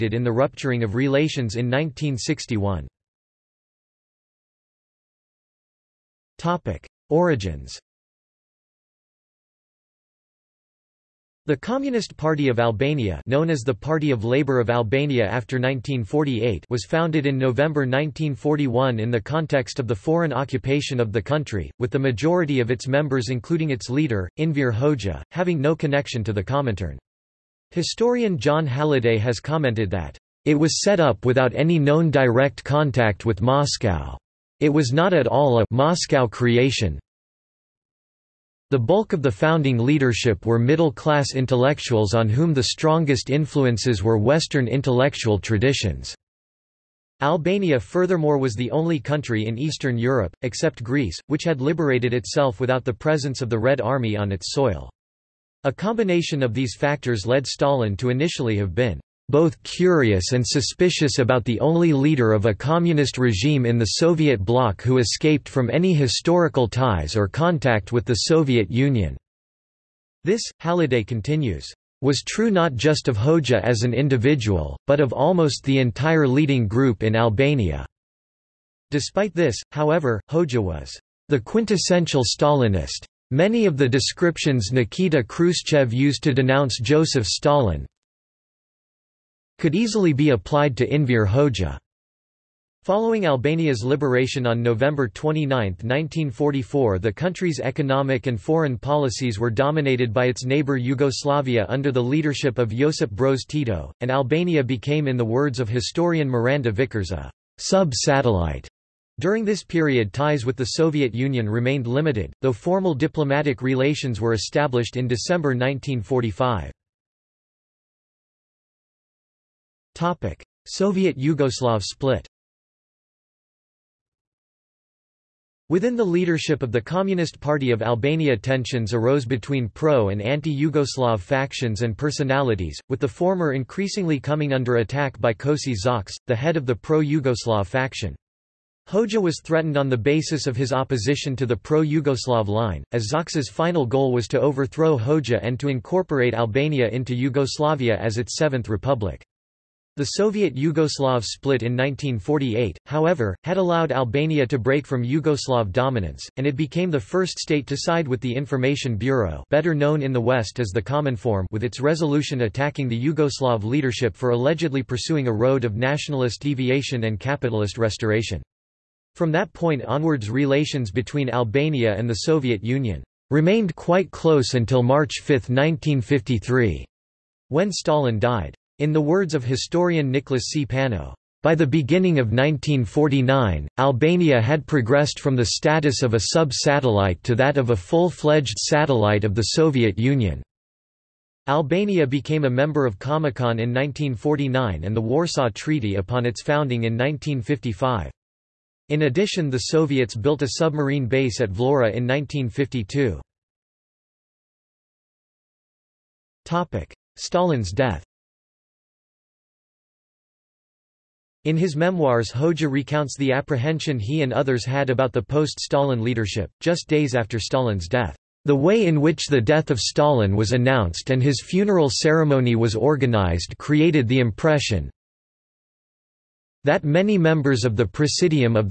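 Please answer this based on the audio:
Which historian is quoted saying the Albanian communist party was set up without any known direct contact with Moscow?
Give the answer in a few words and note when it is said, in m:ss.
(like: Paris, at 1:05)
John Halliday, at 0:28.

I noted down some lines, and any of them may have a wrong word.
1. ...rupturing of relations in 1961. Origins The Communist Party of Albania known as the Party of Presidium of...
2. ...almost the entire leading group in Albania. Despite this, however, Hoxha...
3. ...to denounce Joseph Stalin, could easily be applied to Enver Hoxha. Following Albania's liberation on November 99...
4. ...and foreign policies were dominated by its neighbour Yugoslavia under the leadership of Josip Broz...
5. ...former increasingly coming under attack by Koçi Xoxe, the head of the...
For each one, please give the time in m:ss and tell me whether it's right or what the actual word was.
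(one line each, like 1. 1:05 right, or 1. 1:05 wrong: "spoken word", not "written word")
1. 0:00 wrong: "Labour", not "Presidium"
2. 1:15 right
3. 1:26 wrong: "29", not "99"
4. 1:38 right
5. 2:13 right.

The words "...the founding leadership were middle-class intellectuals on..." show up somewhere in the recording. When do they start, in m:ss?
0:39.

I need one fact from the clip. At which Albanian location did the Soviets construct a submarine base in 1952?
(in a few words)
Vlora.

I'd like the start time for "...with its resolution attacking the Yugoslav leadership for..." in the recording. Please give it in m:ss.
2:41.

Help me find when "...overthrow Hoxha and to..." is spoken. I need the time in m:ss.
2:24.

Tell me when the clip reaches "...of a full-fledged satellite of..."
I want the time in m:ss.
3:07.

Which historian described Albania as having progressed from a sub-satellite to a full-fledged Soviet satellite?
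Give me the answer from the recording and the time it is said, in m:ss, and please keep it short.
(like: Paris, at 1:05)
Nicholas C. Pano, at 3:00.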